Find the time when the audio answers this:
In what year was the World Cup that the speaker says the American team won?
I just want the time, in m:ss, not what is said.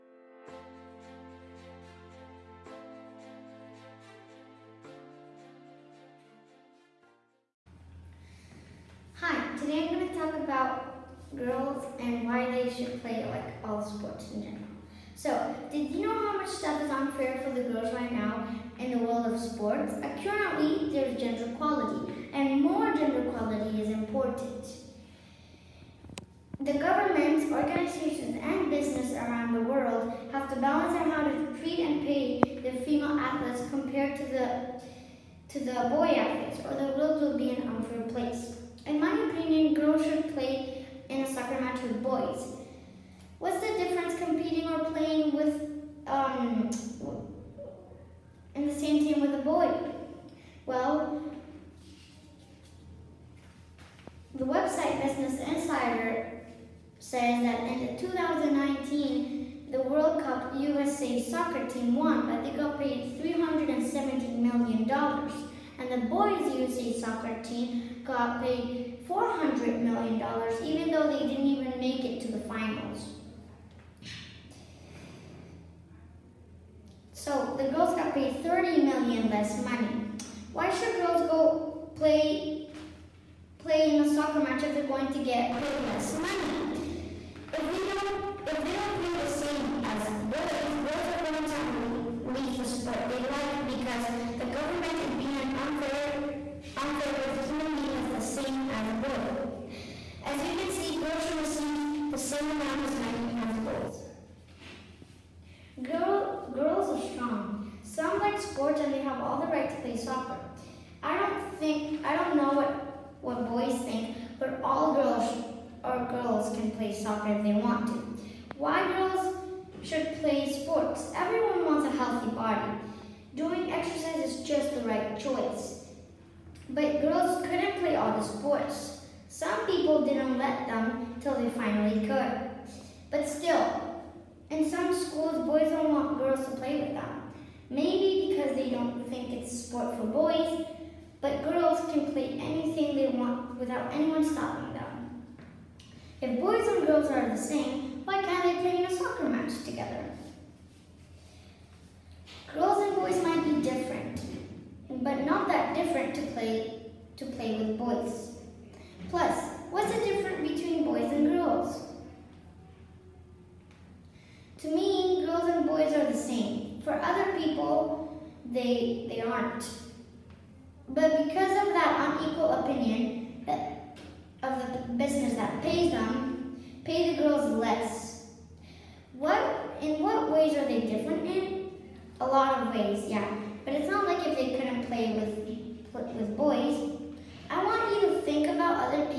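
0:58.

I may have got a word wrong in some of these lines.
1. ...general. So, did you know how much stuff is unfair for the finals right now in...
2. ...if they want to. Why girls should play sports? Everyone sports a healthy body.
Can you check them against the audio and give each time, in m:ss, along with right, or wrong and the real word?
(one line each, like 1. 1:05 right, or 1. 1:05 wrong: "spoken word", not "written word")
1. 0:14 wrong: "girls", not "finals"
2. 1:57 wrong: "wants", not "sports".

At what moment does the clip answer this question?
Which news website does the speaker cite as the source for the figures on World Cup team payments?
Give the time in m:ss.
0:55.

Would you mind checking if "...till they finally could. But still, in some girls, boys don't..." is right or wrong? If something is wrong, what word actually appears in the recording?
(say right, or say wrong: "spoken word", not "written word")
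wrong: "schools", not "girls".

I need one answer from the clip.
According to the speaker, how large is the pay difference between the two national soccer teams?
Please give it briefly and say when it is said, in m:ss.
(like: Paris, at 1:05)
30 million, at 1:18.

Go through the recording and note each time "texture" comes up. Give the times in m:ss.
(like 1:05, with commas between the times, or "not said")
not said.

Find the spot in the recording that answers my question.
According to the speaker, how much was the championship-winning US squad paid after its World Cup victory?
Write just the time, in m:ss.
1:03.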